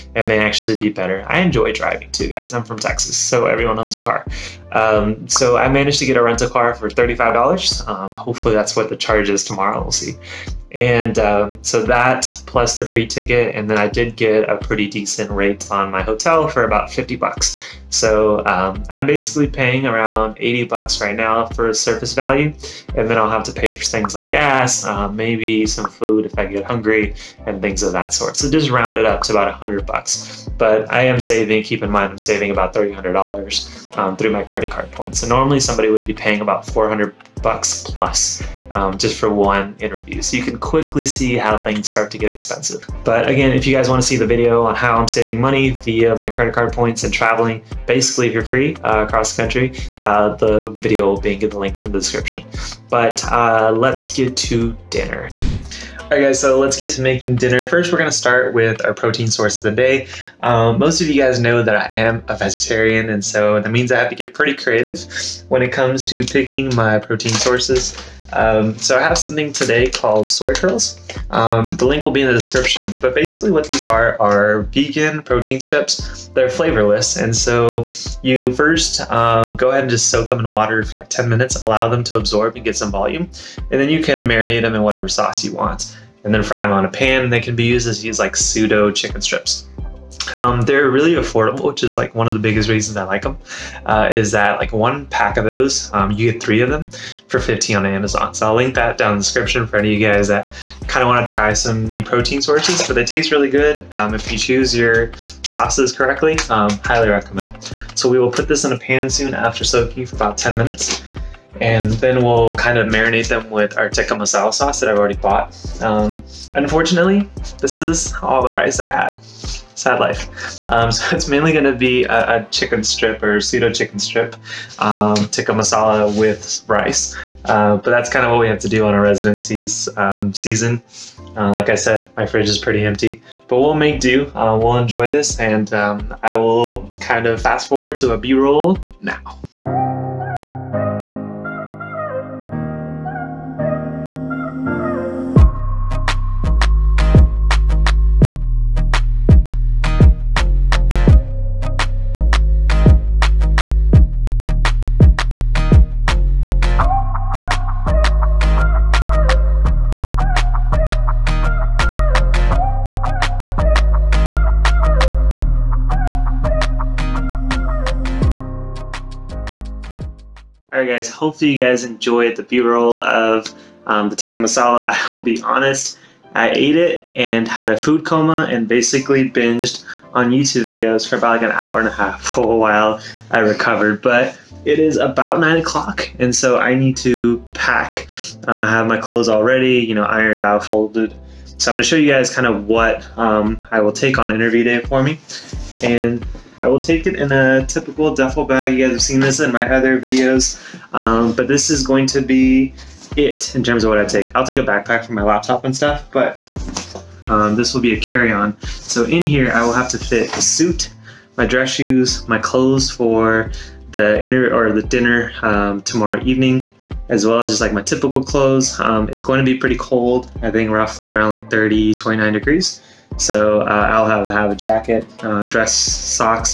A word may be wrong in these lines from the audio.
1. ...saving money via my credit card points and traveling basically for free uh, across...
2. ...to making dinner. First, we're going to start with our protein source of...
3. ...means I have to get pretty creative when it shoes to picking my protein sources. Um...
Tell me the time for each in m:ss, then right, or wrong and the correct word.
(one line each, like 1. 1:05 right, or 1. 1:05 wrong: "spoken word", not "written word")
1. 0:45 right
2. 0:56 right
3. 1:03 wrong: "comes", not "shoes".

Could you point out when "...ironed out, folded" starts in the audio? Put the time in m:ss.
3:10.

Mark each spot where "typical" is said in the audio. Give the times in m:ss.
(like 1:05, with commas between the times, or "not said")
3:17, 3:37.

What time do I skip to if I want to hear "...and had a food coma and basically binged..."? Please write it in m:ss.
2:57.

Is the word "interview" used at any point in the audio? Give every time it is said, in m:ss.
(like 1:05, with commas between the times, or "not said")
0:39, 3:14.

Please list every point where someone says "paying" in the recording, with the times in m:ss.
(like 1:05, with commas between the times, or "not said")
0:19, 0:36.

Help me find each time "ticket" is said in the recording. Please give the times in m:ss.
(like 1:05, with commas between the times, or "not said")
0:13.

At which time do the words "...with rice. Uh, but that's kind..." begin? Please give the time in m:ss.
2:06.